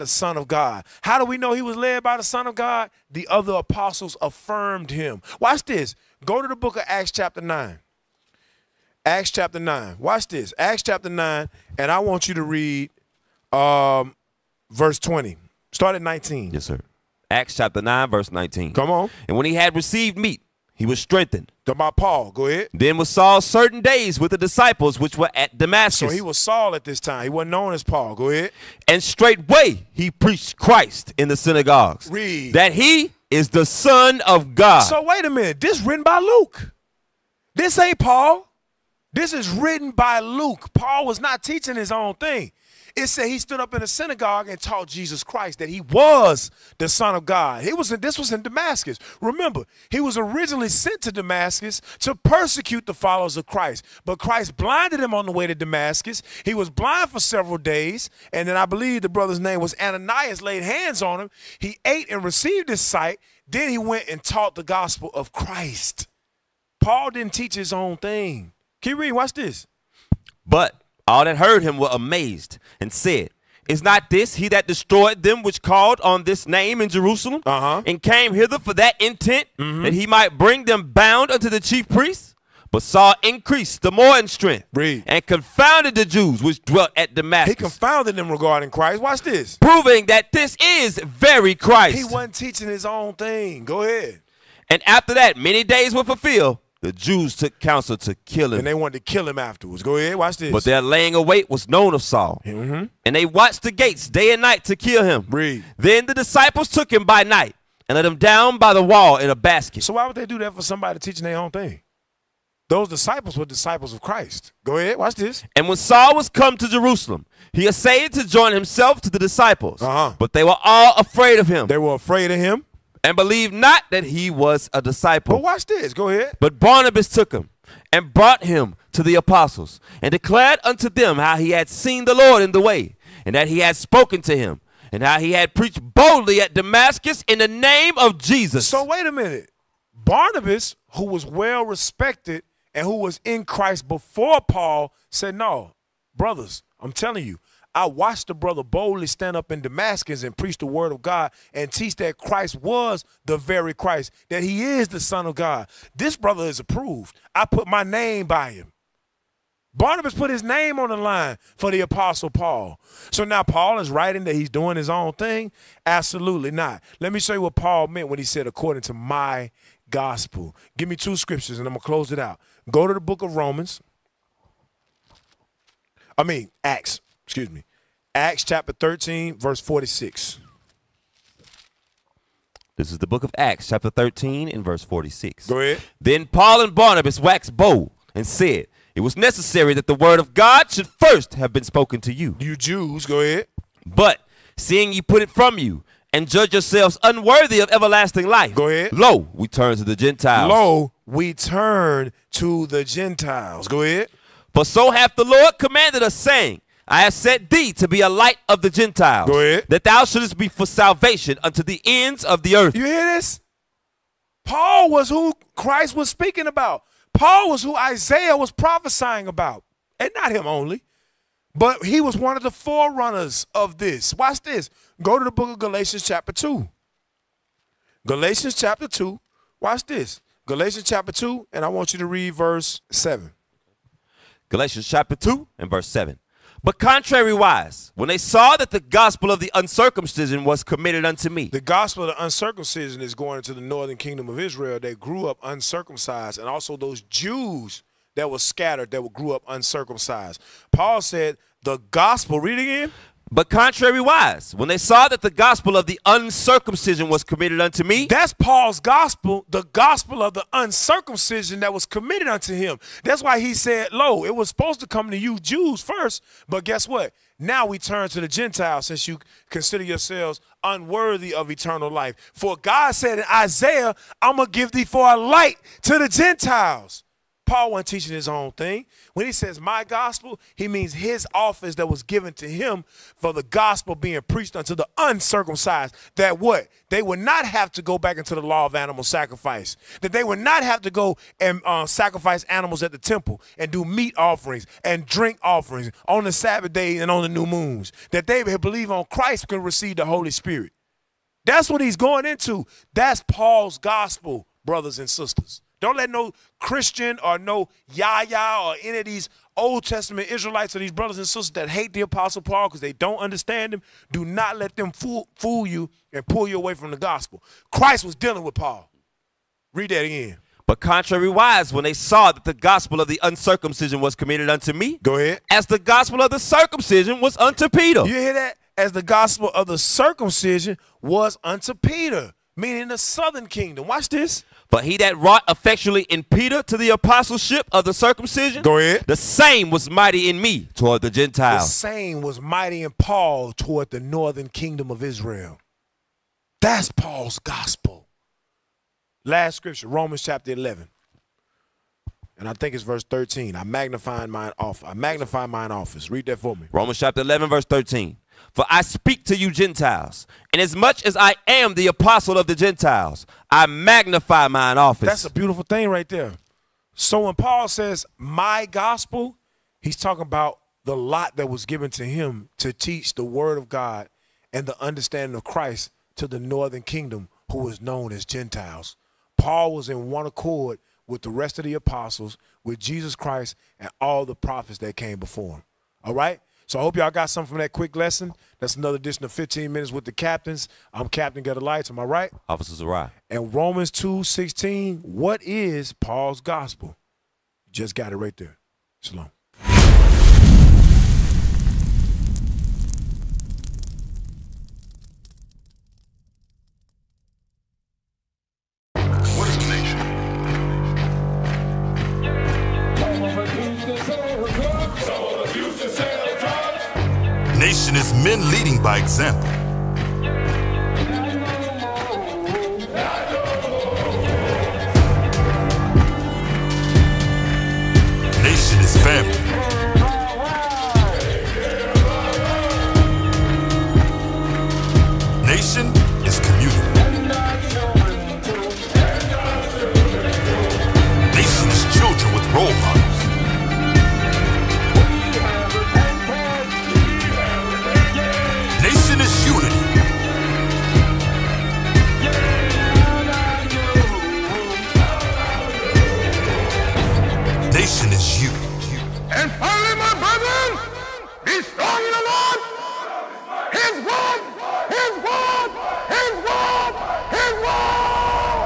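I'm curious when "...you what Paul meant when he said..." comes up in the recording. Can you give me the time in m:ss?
2:47.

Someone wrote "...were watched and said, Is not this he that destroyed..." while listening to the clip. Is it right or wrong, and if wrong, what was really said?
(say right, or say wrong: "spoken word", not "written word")
wrong: "amazed", not "watched".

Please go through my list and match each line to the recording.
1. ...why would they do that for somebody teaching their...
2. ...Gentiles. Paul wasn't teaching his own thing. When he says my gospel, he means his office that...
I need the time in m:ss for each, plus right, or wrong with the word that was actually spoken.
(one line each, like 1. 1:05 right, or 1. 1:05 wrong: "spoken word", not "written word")
1. 1:49 right
2. 4:36 right.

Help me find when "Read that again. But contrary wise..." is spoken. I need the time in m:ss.
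5:19.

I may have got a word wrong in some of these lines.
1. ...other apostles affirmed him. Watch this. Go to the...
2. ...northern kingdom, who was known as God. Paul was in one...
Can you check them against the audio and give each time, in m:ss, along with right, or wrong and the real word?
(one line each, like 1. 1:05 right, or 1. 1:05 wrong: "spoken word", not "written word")
1. 0:03 right
2. 6:16 wrong: "Gentiles", not "God".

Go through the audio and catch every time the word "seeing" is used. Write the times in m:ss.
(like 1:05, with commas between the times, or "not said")
3:14.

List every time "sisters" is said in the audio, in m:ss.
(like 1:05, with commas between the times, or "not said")
5:05, 5:11.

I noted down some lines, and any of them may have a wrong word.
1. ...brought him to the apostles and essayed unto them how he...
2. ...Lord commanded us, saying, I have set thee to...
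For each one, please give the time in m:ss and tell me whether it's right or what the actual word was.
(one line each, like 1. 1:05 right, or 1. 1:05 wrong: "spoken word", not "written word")
1. 2:08 wrong: "declared", not "essayed"
2. 3:25 right.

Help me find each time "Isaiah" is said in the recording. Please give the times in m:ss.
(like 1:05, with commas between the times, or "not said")
3:37, 4:33.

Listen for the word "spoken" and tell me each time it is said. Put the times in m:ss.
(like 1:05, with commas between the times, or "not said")
2:13, 3:11.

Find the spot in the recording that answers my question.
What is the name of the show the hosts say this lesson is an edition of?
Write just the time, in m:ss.
6:29.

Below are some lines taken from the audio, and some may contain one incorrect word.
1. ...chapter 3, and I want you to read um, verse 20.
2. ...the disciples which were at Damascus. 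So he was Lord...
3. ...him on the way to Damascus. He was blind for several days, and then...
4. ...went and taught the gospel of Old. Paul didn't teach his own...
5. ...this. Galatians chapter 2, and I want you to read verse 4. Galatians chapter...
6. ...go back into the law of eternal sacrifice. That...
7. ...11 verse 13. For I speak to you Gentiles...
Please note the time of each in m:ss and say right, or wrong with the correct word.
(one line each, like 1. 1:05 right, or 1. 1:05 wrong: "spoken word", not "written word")
1. 0:10 wrong: "9", not "3"
2. 0:24 wrong: "Saul", not "Lord"
3. 0:54 right
4. 1:03 wrong: "Christ", not "Old"
5. 3:49 wrong: "7", not "4"
6. 4:47 wrong: "animal", not "eternal"
7. 5:57 right.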